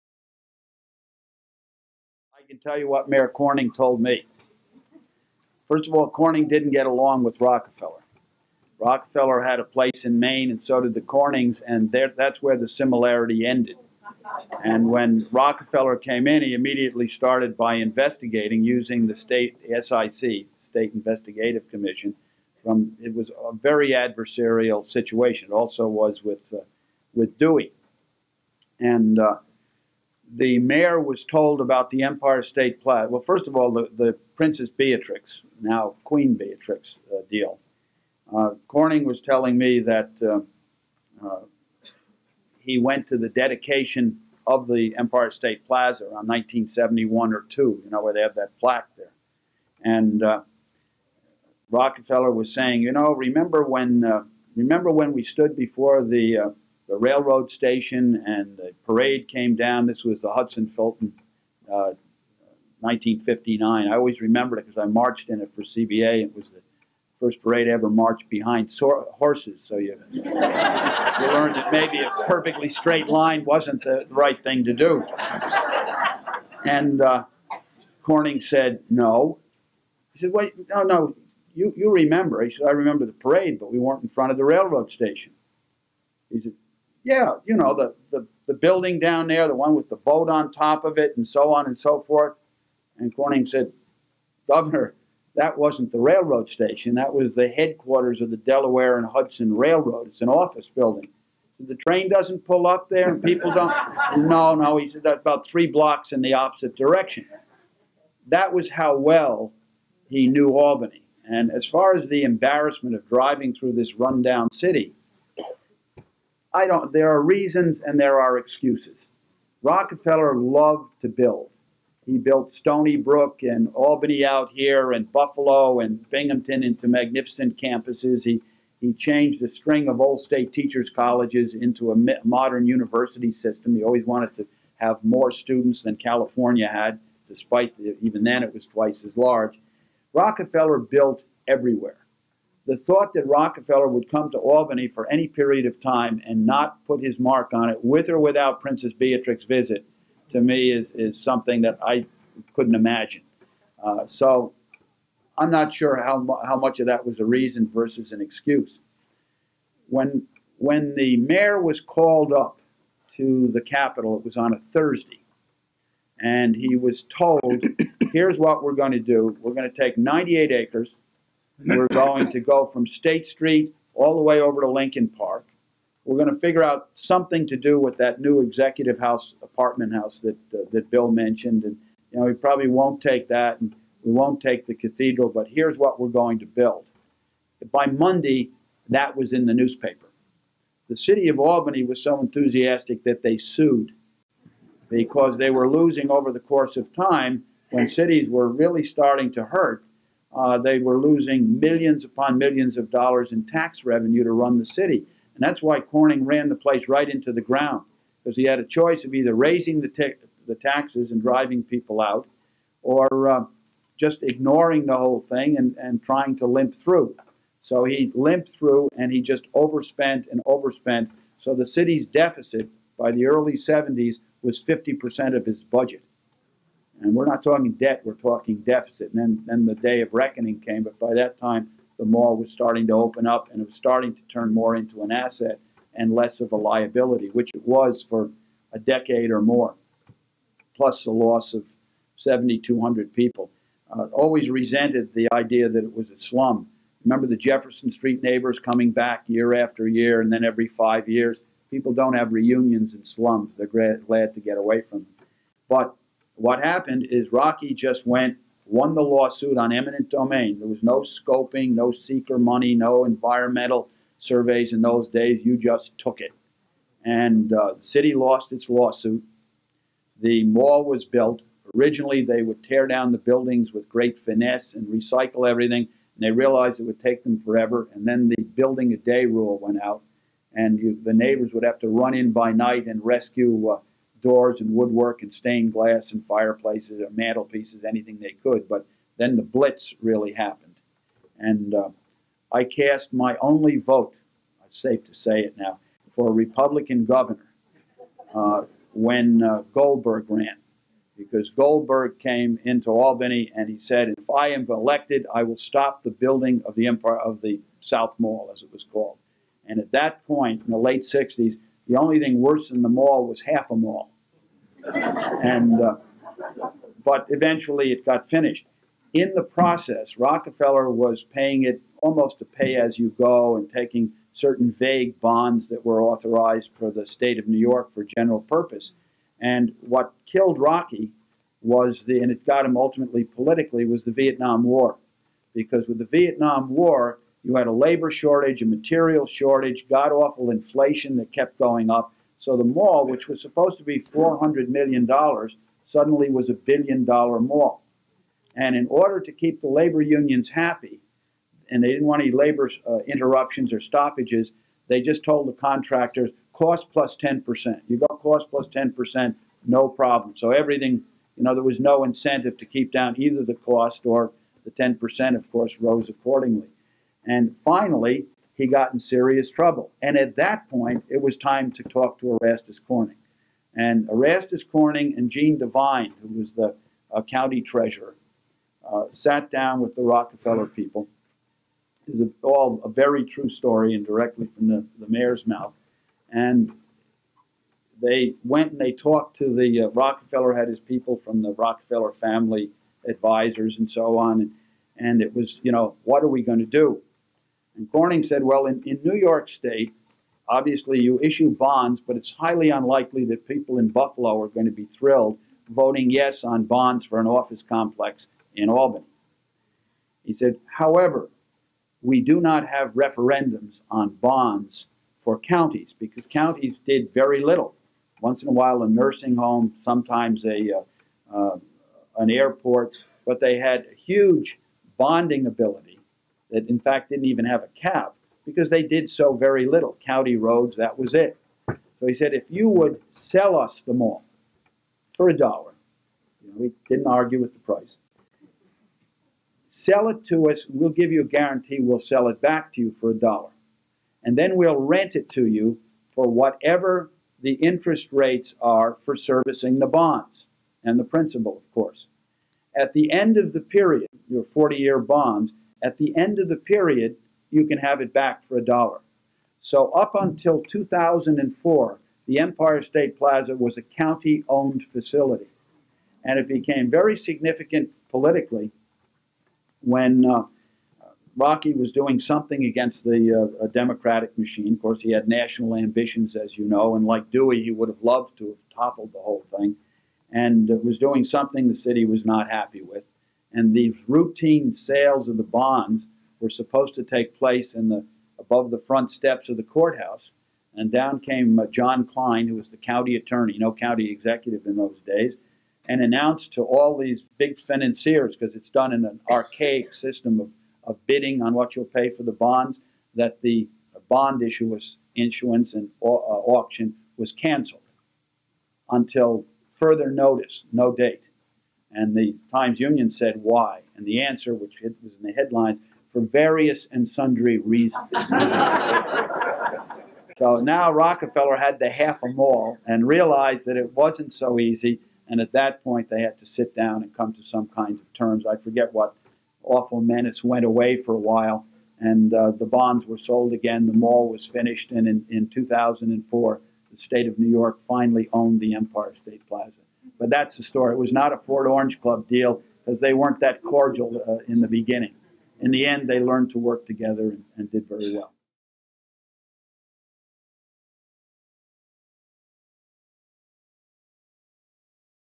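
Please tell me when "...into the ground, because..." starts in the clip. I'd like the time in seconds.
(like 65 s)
207 s.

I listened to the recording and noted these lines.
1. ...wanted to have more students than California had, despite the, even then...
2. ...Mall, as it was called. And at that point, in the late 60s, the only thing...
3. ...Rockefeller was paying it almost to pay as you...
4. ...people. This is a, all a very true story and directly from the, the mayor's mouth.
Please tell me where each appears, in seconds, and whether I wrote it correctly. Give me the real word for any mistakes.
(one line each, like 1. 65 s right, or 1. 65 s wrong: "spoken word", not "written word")
1. 134 s right
2. 308 s right
3. 320 s right
4. 380 s right.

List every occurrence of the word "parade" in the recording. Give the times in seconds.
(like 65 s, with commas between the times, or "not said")
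58 s, 67 s, 83 s.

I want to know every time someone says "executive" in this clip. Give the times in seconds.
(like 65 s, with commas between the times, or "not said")
178 s, 494 s.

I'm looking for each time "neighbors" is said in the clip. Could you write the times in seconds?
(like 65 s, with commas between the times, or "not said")
248 s, 281 s.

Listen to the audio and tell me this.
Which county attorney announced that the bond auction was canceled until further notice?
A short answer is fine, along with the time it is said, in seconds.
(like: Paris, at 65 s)
John Klein, at 491 s.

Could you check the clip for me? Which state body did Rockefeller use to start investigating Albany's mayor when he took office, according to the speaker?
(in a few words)
State Investigative Commission.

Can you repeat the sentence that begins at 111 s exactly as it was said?
And as far as the embarrassment of driving through this rundown city, I don't, there are reasons and there are excuses.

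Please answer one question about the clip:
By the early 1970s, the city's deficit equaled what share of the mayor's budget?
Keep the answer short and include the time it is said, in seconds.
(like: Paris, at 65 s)
50%, at 224 s.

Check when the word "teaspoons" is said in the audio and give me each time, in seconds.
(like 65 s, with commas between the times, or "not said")
not said.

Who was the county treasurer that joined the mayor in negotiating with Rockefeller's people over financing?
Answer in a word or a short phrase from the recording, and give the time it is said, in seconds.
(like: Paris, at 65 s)
Gene Devine, at 375 s.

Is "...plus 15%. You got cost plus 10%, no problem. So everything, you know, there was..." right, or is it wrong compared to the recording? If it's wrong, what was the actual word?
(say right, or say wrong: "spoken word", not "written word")
wrong: "10", not "15".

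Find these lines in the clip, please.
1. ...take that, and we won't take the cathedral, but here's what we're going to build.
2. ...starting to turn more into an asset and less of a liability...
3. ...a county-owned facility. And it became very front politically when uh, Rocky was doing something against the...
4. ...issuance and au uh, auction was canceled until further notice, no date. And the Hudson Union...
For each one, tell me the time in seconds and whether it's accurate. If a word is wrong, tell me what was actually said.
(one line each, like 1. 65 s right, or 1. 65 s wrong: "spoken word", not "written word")
1. 183 s right
2. 233 s right
3. 463 s wrong: "significant", not "front"
4. 505 s wrong: "Times", not "Hudson".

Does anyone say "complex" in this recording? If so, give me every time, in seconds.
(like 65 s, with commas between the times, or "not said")
407 s.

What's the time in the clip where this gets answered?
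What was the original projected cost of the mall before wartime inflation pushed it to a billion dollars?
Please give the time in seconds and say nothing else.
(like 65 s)
343 s.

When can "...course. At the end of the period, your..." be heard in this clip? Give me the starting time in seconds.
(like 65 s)
451 s.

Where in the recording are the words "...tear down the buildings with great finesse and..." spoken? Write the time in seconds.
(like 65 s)
272 s.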